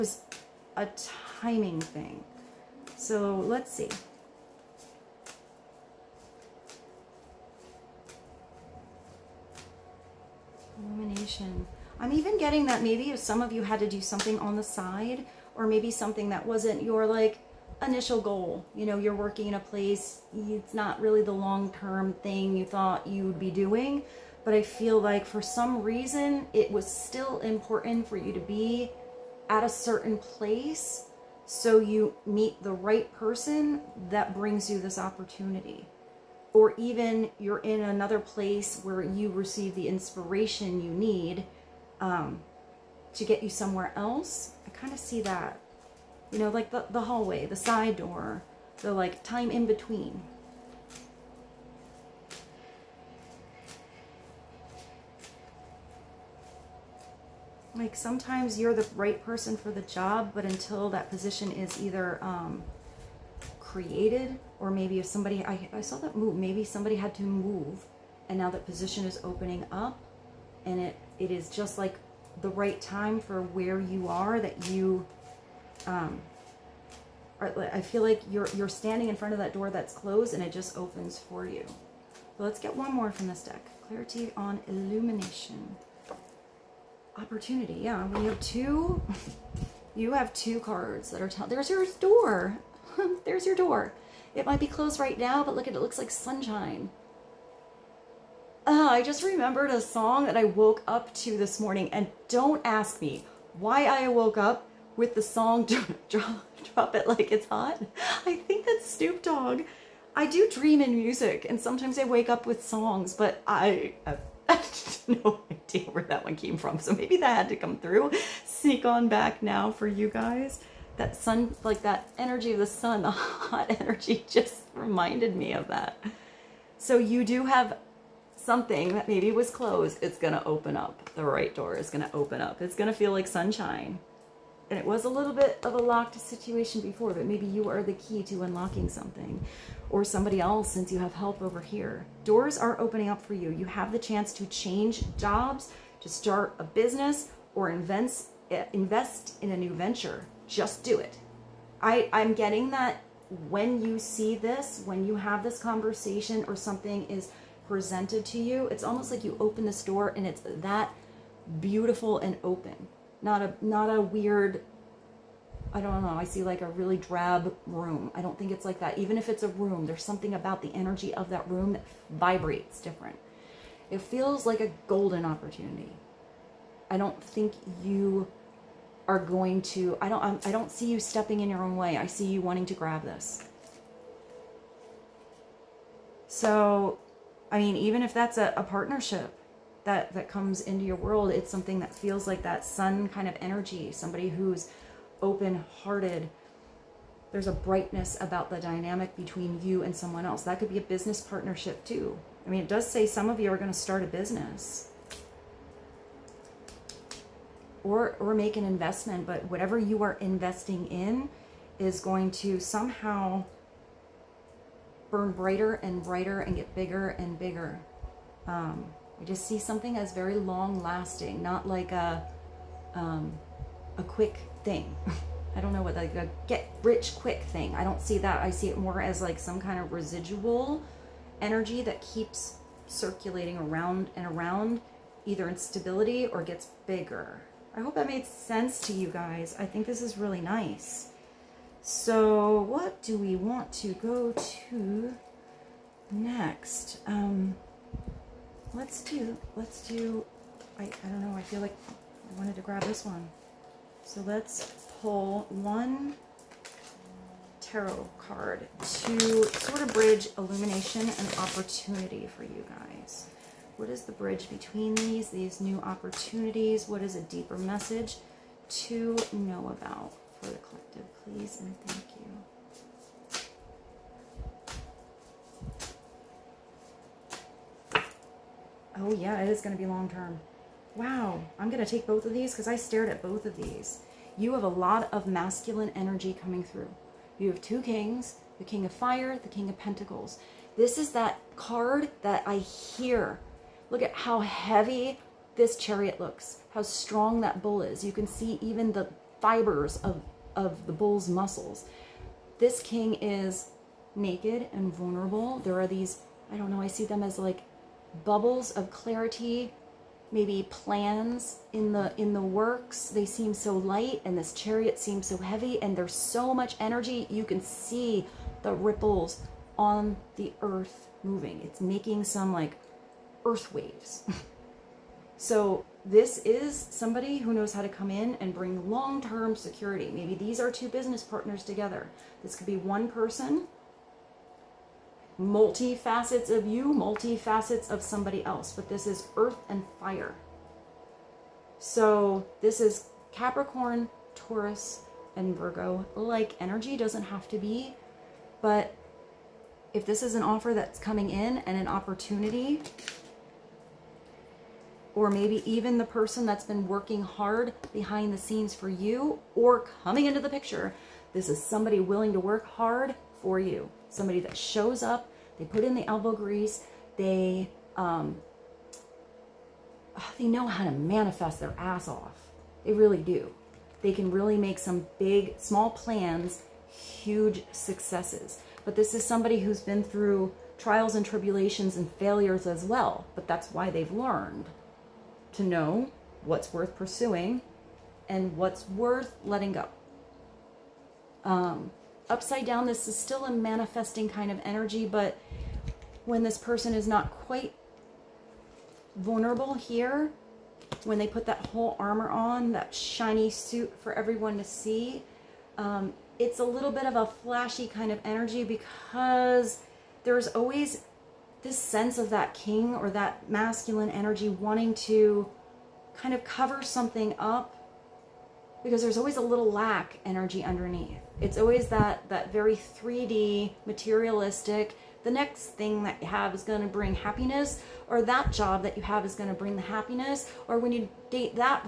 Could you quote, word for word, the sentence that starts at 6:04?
Somebody that shows up, they put in the elbow grease, they, um, ah, they know how to manifest their ass off.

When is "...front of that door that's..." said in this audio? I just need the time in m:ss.
1:19.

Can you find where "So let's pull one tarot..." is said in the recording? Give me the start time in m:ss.
4:14.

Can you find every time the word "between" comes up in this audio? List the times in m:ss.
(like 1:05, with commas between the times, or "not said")
0:49, 3:19, 4:24.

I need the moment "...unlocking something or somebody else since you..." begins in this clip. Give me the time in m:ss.
2:18.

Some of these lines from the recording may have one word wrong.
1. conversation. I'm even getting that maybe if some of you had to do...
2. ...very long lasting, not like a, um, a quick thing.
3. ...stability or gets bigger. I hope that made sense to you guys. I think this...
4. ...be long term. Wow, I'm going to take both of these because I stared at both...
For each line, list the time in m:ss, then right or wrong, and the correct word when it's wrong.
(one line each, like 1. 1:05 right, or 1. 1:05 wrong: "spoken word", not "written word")
1. 0:10 wrong: "illumination", not "conversation"
2. 3:40 right
3. 3:55 right
4. 4:39 right.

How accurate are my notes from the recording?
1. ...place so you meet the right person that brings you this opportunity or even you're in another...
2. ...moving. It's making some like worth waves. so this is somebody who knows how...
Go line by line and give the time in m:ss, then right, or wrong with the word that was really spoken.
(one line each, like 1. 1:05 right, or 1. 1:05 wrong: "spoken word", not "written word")
1. 0:30 right
2. 5:21 wrong: "earth", not "worth".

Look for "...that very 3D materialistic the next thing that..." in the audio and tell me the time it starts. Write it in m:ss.
7:02.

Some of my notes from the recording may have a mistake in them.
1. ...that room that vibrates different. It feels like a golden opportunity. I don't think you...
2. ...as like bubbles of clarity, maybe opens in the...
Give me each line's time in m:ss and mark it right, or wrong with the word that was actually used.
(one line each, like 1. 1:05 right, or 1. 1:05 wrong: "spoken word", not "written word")
1. 2:51 right
2. 5:07 wrong: "plans", not "opens".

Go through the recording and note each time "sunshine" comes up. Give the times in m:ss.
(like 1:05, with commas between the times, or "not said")
1:36, 2:13.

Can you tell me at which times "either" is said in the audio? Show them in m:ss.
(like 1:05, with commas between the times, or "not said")
1:01, 3:55.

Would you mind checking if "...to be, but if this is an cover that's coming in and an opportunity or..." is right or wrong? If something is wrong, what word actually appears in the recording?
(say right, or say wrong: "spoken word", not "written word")
wrong: "offer", not "cover".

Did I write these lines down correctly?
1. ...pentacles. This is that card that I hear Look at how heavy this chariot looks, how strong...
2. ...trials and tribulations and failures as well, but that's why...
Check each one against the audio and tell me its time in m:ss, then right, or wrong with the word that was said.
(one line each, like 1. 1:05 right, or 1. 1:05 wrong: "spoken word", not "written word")
1. 4:49 right
2. 6:20 right.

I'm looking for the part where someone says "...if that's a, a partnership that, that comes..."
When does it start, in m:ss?
3:08.